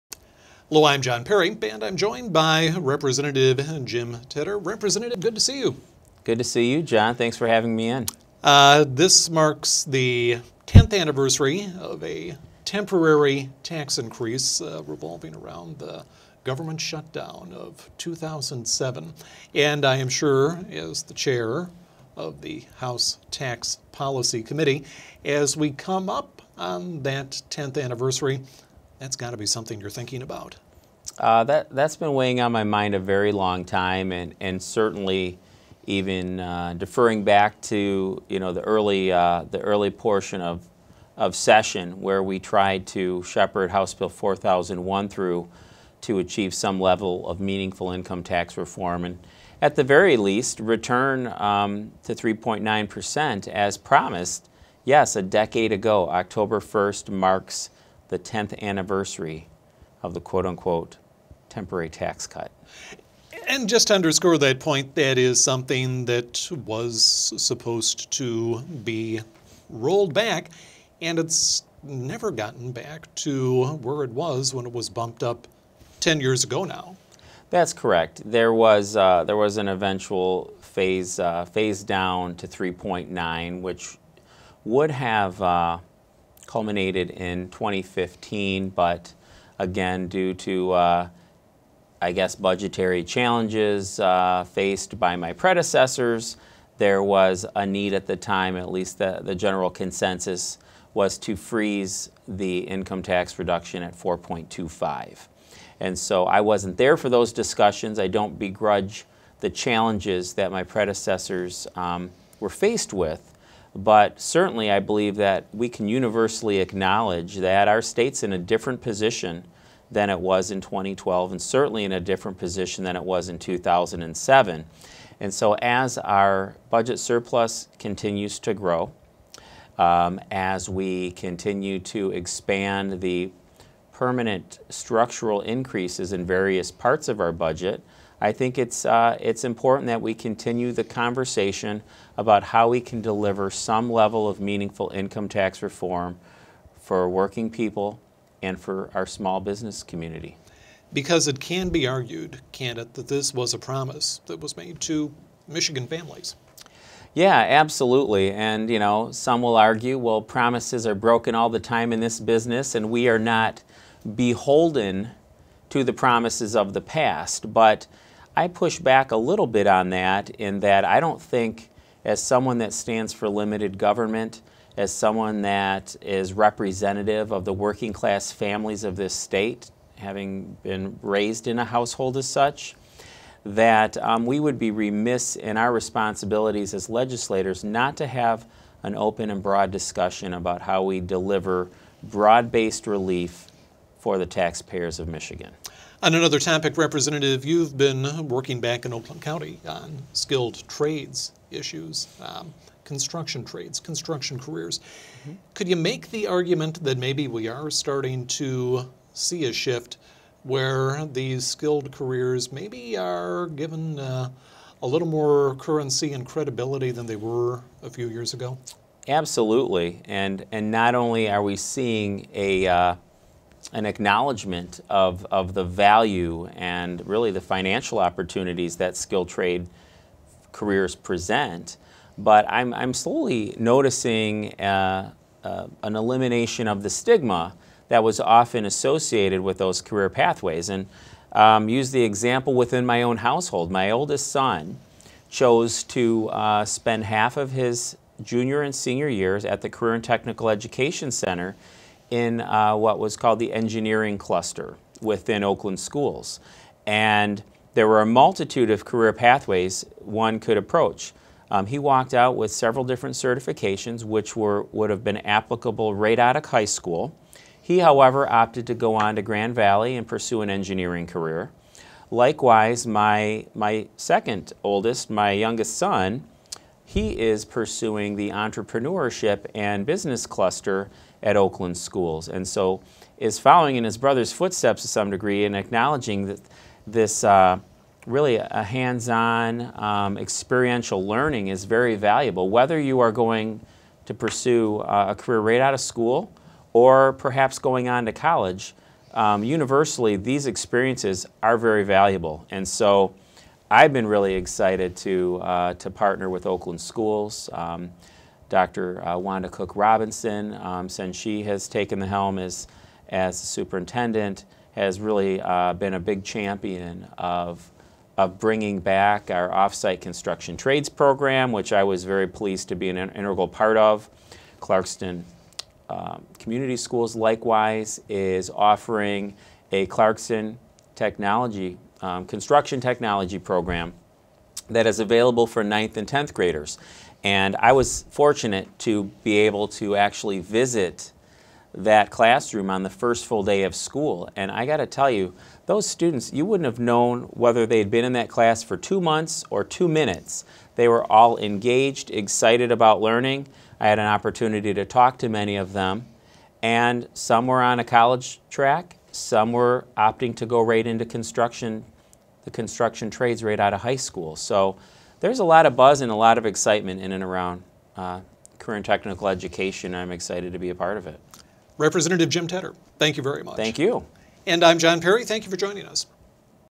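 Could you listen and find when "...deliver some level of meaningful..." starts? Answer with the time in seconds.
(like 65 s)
143 s.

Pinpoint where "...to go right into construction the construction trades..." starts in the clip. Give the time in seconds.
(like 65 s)
360 s.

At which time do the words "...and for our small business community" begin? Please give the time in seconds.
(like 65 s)
148 s.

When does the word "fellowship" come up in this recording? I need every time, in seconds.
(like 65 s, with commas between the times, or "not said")
not said.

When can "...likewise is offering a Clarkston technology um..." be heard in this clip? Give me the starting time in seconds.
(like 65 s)
327 s.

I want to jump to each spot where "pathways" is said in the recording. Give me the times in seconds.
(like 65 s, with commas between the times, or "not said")
240 s, 259 s.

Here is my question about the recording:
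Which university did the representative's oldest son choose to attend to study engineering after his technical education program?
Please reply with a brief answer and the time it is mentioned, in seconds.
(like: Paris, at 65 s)
Grand Valley, at 269 s.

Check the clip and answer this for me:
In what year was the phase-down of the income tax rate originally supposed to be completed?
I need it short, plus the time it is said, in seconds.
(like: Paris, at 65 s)
2015, at 87 s.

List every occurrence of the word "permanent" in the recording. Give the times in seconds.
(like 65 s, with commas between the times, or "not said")
133 s.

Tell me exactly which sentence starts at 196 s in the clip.
On another topic, Representative, you've been working back in Oakland County on skilled trades issues, um, construction trades, construction careers.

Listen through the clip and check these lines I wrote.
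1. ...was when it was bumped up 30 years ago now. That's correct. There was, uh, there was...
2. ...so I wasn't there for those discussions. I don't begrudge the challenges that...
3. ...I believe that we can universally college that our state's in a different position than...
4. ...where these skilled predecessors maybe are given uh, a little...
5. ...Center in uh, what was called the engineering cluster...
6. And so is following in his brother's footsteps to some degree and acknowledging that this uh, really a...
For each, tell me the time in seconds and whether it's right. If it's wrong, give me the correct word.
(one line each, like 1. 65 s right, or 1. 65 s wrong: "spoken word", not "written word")
1. 74 s wrong: "10", not "30"
2. 105 s right
3. 114 s wrong: "acknowledge", not "college"
4. 210 s wrong: "careers", not "predecessors"
5. 251 s right
6. 282 s right.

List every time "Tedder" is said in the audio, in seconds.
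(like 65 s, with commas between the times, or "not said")
4 s, 372 s.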